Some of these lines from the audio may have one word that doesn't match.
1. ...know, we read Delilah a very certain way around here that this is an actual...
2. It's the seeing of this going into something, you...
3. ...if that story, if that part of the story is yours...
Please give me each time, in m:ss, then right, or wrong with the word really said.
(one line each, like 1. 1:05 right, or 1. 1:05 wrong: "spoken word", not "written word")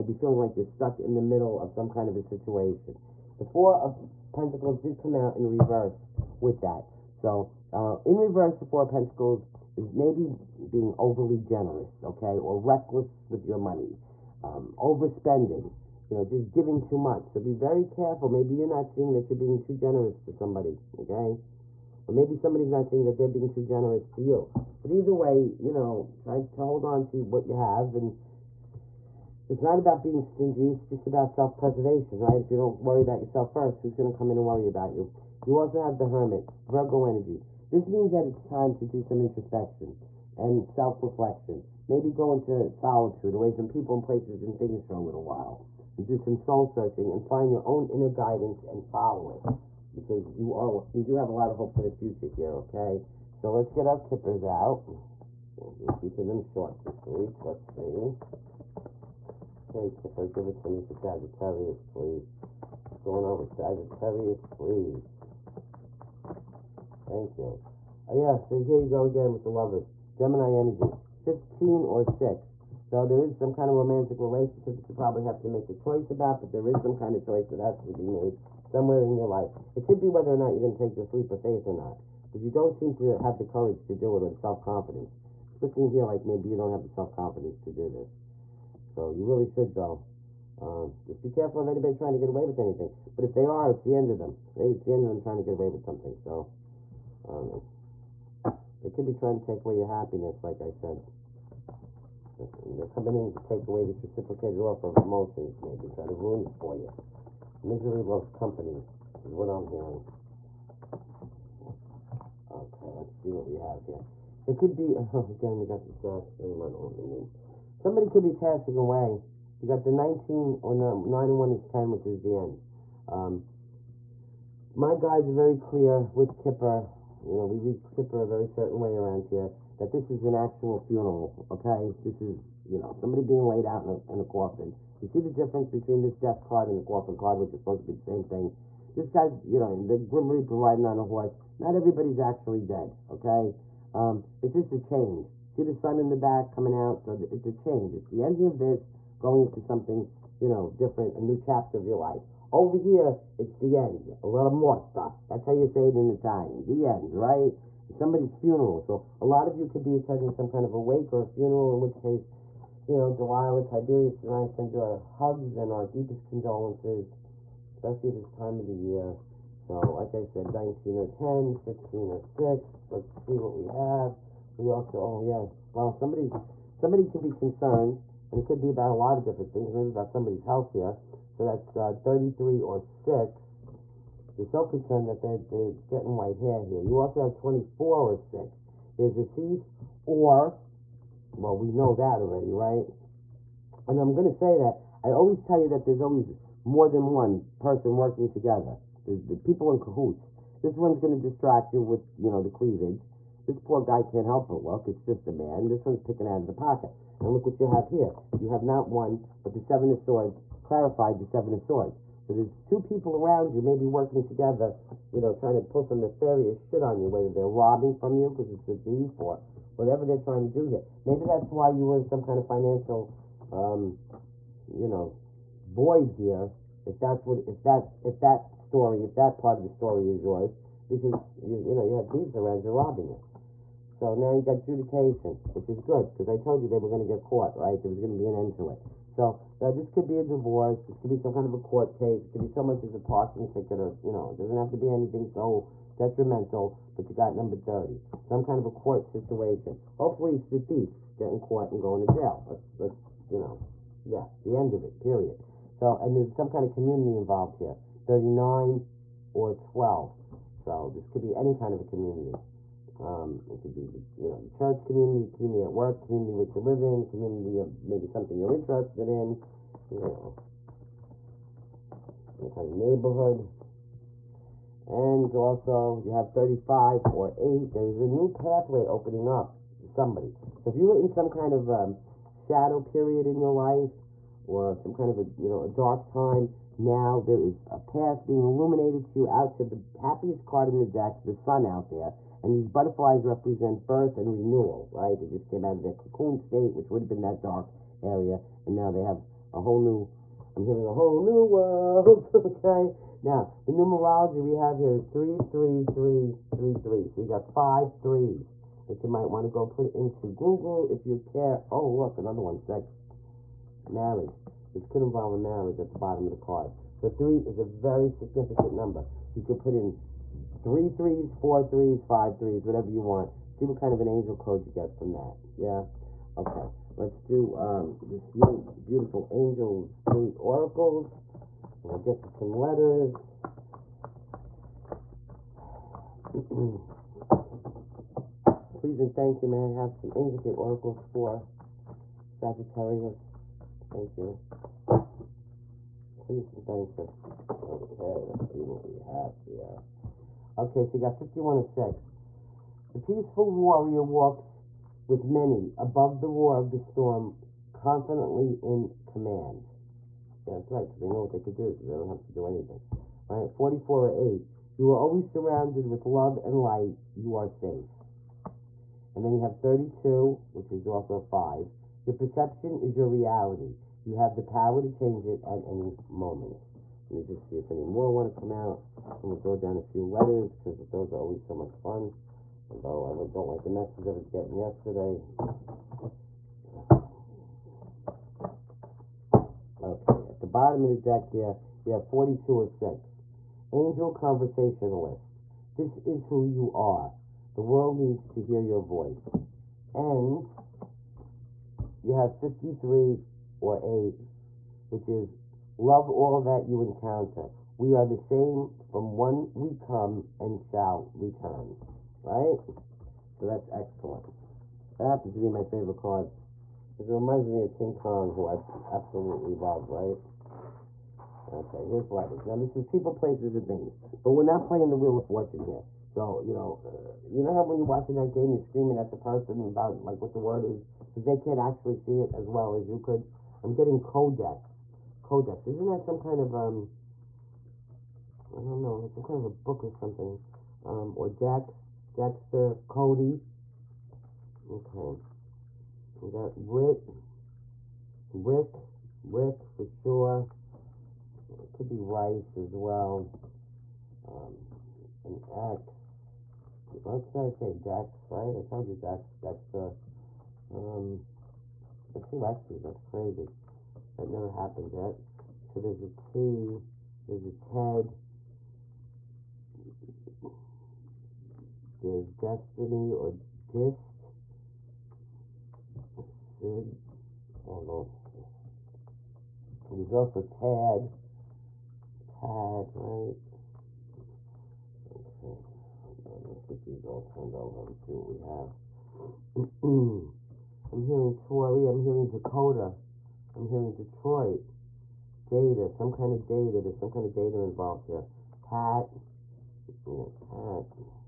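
1. 2:07 wrong: "Kipper", not "Delilah"
2. 2:27 wrong: "ending", not "seeing"
3. 3:48 right.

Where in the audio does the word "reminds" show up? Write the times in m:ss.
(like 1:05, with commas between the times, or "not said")
6:57.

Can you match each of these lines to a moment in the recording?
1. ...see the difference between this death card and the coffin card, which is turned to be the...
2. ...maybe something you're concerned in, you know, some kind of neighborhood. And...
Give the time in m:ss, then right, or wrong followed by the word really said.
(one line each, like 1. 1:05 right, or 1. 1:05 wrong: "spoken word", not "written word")
1. 2:15 wrong: "supposed", not "turned"
2. 4:27 wrong: "interested", not "concerned".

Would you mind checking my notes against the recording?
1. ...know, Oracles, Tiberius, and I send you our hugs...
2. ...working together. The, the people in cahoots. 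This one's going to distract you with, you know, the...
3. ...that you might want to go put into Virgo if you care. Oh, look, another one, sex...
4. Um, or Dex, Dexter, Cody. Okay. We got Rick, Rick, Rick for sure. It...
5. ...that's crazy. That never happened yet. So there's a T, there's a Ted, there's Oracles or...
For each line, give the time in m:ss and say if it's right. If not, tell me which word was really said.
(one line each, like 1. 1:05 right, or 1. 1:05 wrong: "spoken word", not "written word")
1. 2:42 wrong: "Delilah", not "Oracles"
2. 3:17 right
3. 5:08 wrong: "Google", not "Virgo"
4. 7:20 right
5. 7:42 wrong: "Destiny", not "Oracles".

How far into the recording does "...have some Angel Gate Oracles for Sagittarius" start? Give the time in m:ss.
5:39.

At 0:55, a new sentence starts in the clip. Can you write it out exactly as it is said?
We're keeping them short this week.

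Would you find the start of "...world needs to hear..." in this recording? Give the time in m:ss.
6:37.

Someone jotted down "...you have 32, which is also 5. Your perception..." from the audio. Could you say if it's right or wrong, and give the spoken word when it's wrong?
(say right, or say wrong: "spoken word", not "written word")
right.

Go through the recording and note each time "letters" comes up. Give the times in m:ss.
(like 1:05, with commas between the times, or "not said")
5:32, 6:20, 7:02.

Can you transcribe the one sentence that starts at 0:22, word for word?
Or maybe somebody's not seeing that they're being too generous to you.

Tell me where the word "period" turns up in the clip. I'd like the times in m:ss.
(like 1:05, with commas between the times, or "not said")
4:14, 4:42.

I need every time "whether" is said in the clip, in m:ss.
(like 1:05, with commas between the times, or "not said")
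1:20, 3:37.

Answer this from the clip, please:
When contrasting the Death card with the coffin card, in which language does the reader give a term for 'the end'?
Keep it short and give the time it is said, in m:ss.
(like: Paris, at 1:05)
Italian, at 2:36.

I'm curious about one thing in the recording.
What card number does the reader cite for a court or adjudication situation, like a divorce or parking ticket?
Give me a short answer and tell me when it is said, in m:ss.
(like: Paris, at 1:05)
30, at 4:07.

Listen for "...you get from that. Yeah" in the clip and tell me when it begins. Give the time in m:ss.
5:24.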